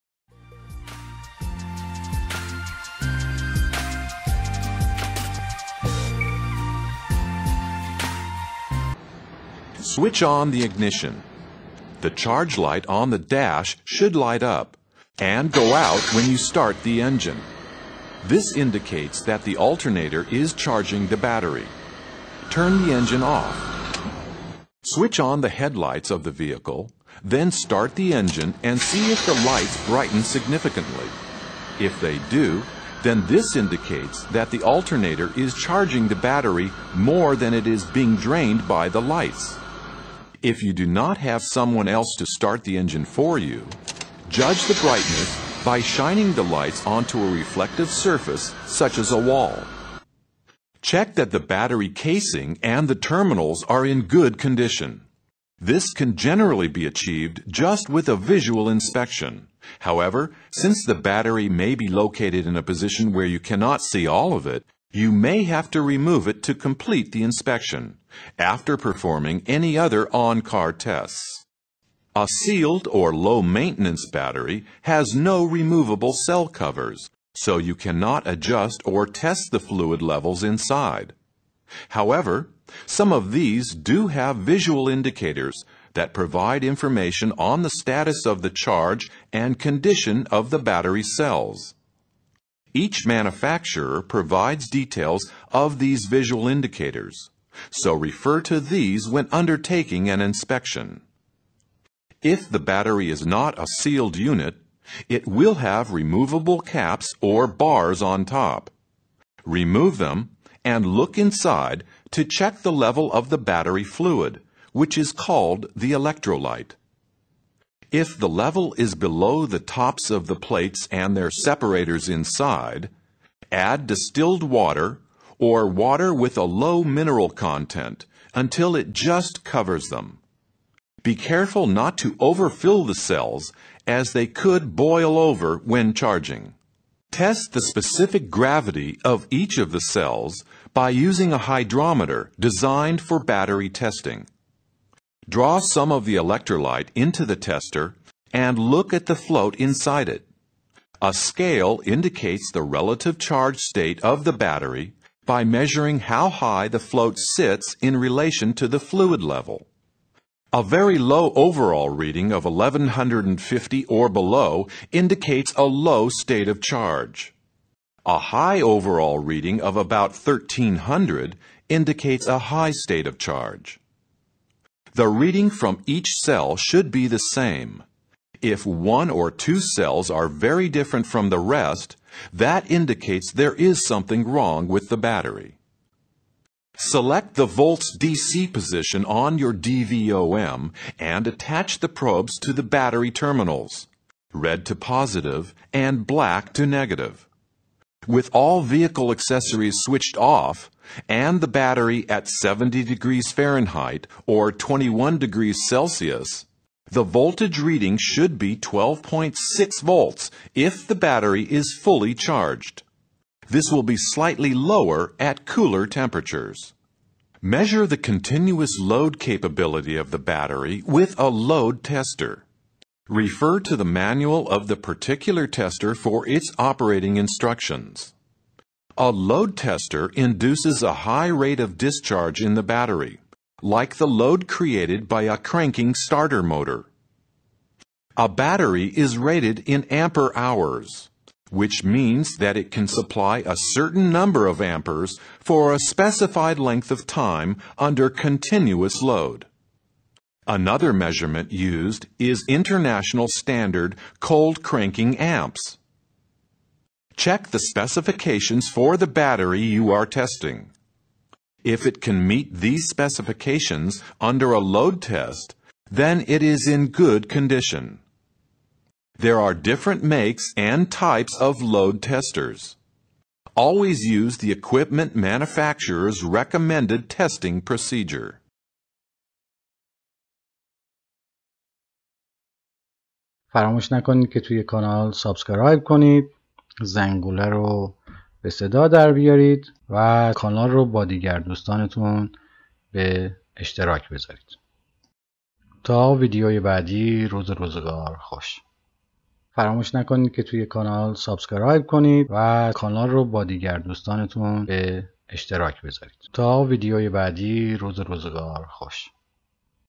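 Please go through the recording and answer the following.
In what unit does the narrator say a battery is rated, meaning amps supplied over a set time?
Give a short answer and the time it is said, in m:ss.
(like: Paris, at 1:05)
ampere hours, at 3:59.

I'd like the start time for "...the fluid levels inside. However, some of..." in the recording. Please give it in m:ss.
1:19.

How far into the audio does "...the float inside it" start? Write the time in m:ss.
2:29.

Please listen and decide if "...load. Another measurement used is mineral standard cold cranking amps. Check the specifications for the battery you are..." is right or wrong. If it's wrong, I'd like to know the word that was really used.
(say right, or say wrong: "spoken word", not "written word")
wrong: "international", not "mineral".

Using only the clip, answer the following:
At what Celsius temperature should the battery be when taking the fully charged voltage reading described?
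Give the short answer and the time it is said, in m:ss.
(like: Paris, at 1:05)
21 degrees Celsius, at 3:24.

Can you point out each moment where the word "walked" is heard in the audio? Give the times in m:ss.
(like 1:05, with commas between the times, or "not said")
not said.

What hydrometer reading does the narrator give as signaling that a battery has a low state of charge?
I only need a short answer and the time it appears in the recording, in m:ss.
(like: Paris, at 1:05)
1150, at 2:42.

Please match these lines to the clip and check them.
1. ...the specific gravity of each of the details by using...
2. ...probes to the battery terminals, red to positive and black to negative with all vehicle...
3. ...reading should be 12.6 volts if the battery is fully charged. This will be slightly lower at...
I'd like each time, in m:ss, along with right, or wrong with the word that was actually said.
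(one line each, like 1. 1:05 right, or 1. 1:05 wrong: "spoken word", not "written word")
1. 2:17 wrong: "cells", not "details"
2. 3:11 right
3. 3:27 right.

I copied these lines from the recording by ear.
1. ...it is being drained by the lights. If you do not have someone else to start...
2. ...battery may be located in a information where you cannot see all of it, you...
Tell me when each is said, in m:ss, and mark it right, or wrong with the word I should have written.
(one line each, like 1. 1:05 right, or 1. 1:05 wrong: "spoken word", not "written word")
1. 0:37 right
2. 1:00 wrong: "position", not "information".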